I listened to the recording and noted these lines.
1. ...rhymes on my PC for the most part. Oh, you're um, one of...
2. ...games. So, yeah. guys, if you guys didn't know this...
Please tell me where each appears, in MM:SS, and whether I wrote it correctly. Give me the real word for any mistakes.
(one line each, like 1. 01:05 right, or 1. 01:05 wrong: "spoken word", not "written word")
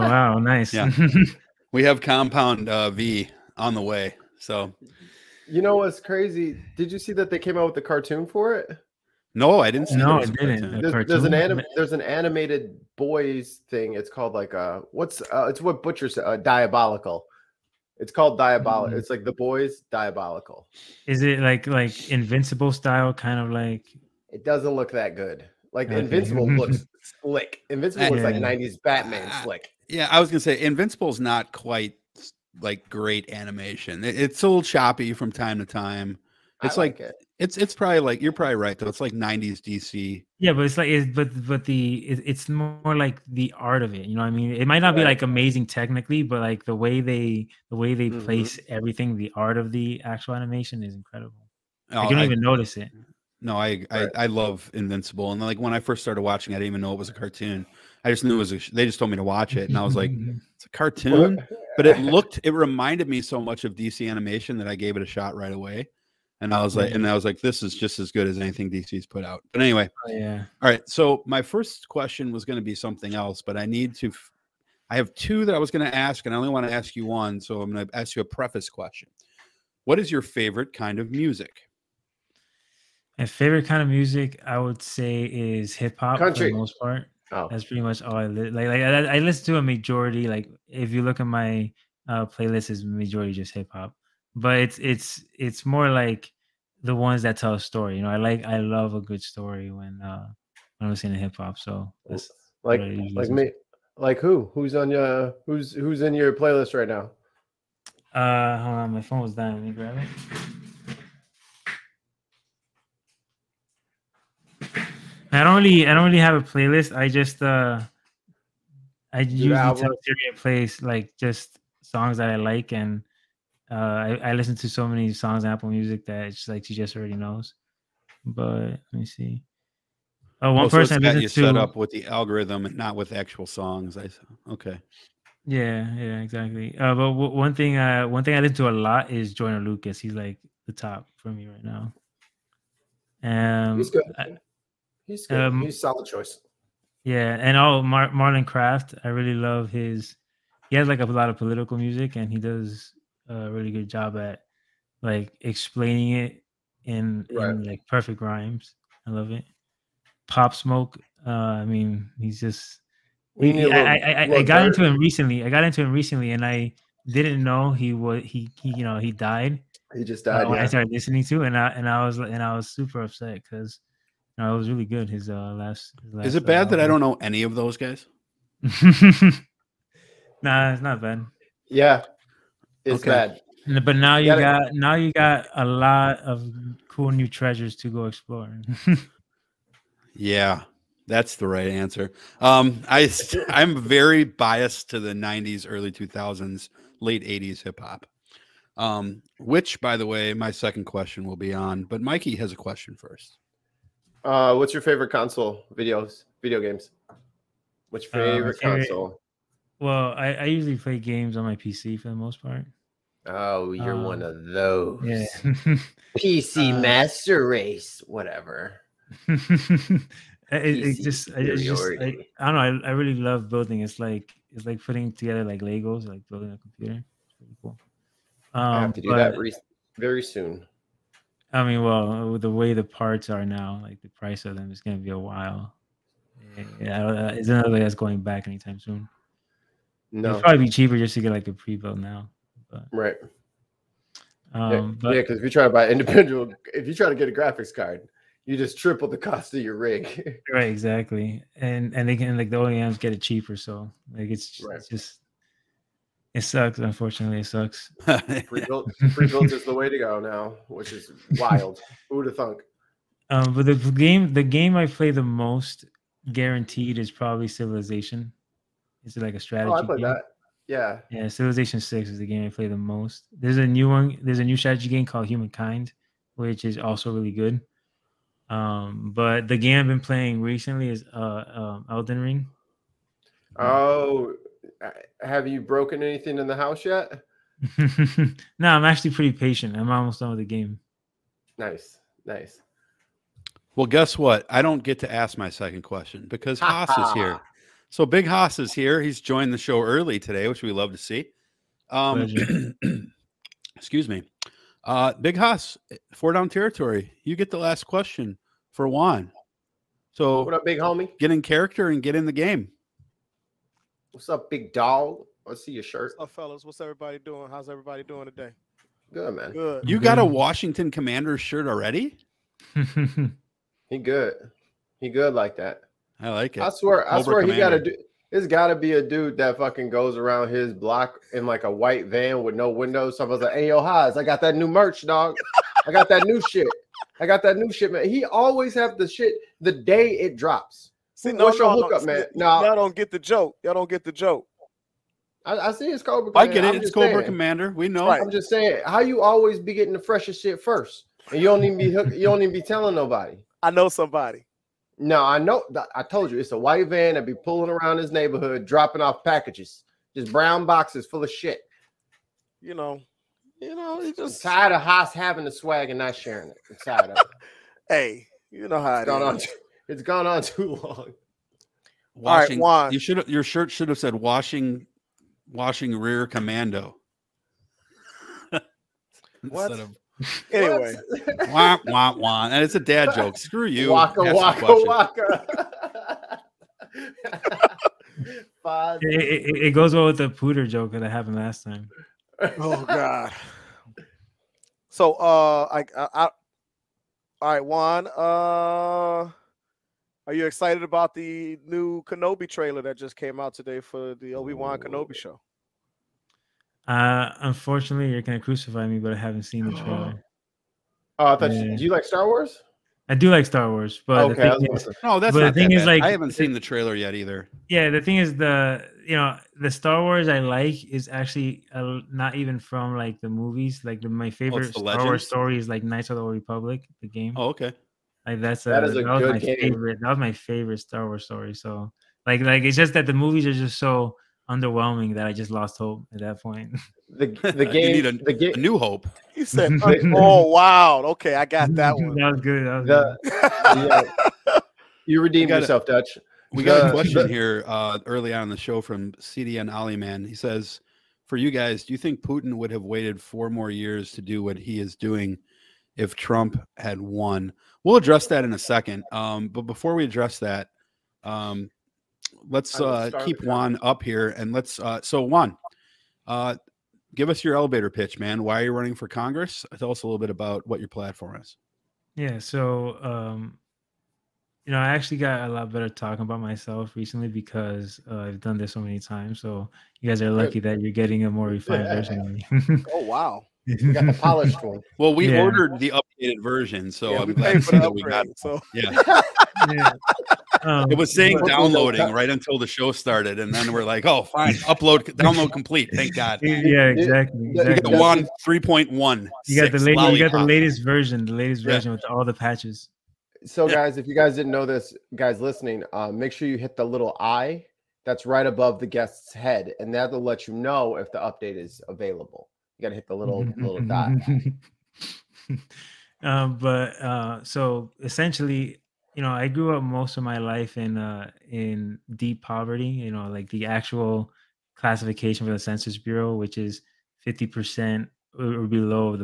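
1. 03:30 wrong: "games", not "rhymes"
2. 08:22 wrong: "patches", not "games".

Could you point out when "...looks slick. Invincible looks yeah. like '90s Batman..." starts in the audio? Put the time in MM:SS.
00:26.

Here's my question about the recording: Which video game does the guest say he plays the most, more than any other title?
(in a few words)
Civilization Six.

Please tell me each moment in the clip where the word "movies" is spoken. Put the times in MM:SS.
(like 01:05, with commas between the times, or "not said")
07:03, 07:13.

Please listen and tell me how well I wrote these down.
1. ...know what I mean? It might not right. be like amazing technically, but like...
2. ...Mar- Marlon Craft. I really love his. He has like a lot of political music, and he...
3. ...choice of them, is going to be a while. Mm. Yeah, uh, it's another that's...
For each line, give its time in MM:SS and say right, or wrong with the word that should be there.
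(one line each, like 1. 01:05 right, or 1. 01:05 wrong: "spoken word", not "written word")
1. 00:44 right
2. 02:27 right
3. 03:54 wrong: "price", not "choice".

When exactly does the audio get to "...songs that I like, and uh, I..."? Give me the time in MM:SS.
02:01.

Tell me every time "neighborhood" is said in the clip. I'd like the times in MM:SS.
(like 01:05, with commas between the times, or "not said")
05:58.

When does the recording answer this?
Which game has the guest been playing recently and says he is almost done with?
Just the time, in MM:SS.
04:41.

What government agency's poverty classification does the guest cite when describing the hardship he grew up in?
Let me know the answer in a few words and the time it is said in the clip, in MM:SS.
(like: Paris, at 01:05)
Census Bureau, at 08:45.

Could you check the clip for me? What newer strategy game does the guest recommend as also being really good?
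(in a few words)
Humankind.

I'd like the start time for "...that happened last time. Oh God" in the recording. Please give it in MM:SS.
06:30.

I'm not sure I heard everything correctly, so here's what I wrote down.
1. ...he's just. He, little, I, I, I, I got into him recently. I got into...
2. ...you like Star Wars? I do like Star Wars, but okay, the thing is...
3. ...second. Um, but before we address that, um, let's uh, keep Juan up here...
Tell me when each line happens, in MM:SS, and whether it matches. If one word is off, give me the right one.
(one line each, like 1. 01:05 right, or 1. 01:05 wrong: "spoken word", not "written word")
1. 02:42 right
2. 06:51 right
3. 07:38 right.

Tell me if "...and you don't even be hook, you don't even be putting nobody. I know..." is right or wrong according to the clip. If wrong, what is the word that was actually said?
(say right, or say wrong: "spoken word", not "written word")
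wrong: "telling", not "putting".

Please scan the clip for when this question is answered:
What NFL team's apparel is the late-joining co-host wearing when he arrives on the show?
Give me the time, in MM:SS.
05:20.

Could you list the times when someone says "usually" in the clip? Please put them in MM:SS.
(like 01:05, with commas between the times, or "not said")
01:59, 03:30.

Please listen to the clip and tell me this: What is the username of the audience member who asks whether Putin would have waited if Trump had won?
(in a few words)
CDN Ali Man.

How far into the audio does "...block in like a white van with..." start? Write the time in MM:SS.
05:30.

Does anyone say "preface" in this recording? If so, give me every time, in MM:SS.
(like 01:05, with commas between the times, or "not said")
01:18.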